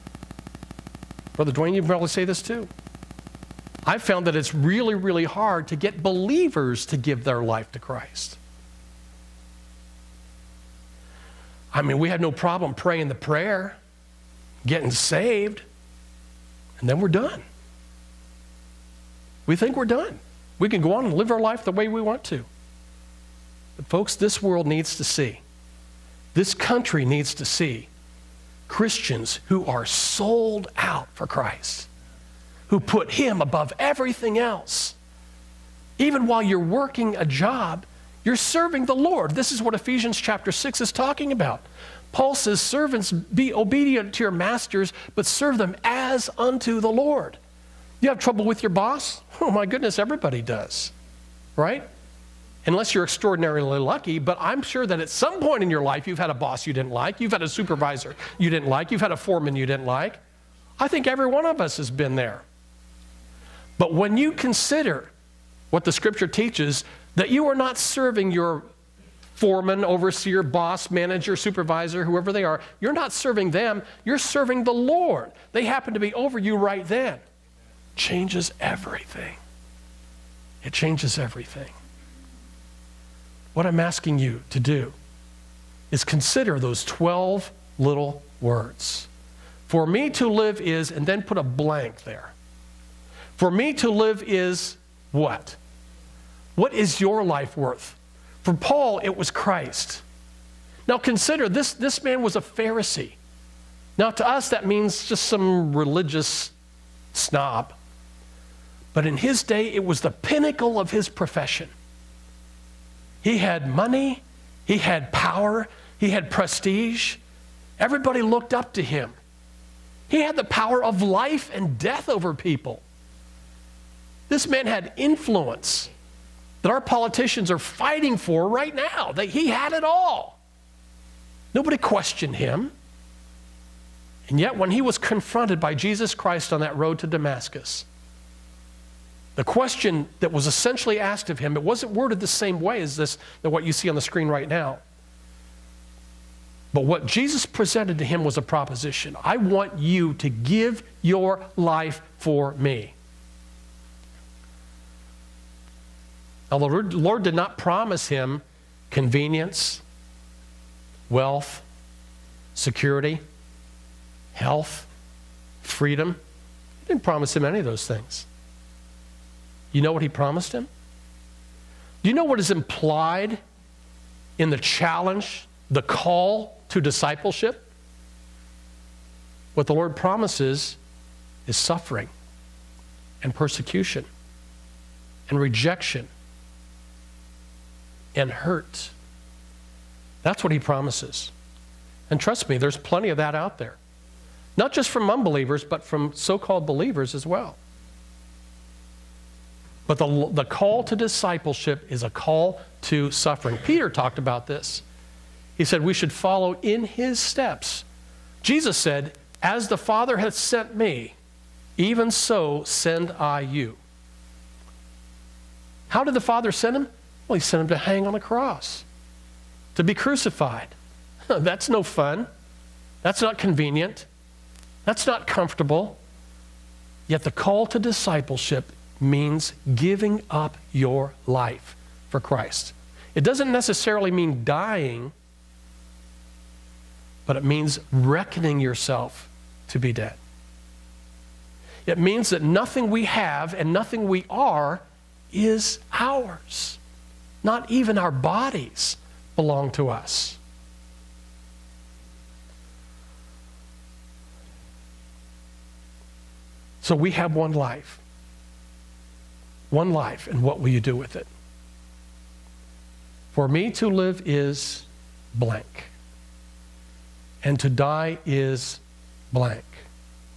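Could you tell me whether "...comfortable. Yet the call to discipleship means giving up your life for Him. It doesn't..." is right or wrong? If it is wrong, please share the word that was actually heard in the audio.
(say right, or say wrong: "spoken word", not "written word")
wrong: "Christ", not "Him".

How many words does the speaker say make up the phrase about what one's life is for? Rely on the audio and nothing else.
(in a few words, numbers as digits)
12.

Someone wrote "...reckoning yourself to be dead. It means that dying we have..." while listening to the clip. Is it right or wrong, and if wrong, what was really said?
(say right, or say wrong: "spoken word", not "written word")
wrong: "nothing", not "dying".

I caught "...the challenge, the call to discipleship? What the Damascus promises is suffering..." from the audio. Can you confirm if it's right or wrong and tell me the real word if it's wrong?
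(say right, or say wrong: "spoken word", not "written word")
wrong: "Lord", not "Damascus".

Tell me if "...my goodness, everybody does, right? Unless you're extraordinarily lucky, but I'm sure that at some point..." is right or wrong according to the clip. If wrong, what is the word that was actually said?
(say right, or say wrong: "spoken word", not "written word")
right.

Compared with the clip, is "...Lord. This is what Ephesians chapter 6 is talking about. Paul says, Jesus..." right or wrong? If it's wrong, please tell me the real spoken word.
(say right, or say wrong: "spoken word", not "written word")
wrong: "Servants", not "Jesus".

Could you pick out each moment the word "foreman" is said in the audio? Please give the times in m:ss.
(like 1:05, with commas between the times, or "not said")
0:59, 1:09.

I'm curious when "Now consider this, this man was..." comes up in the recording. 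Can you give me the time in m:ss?
1:40.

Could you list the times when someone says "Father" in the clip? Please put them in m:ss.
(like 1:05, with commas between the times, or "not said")
3:29, 3:36.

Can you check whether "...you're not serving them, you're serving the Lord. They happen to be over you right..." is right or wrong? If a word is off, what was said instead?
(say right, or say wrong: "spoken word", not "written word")
right.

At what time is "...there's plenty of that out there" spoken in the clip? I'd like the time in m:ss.
3:12.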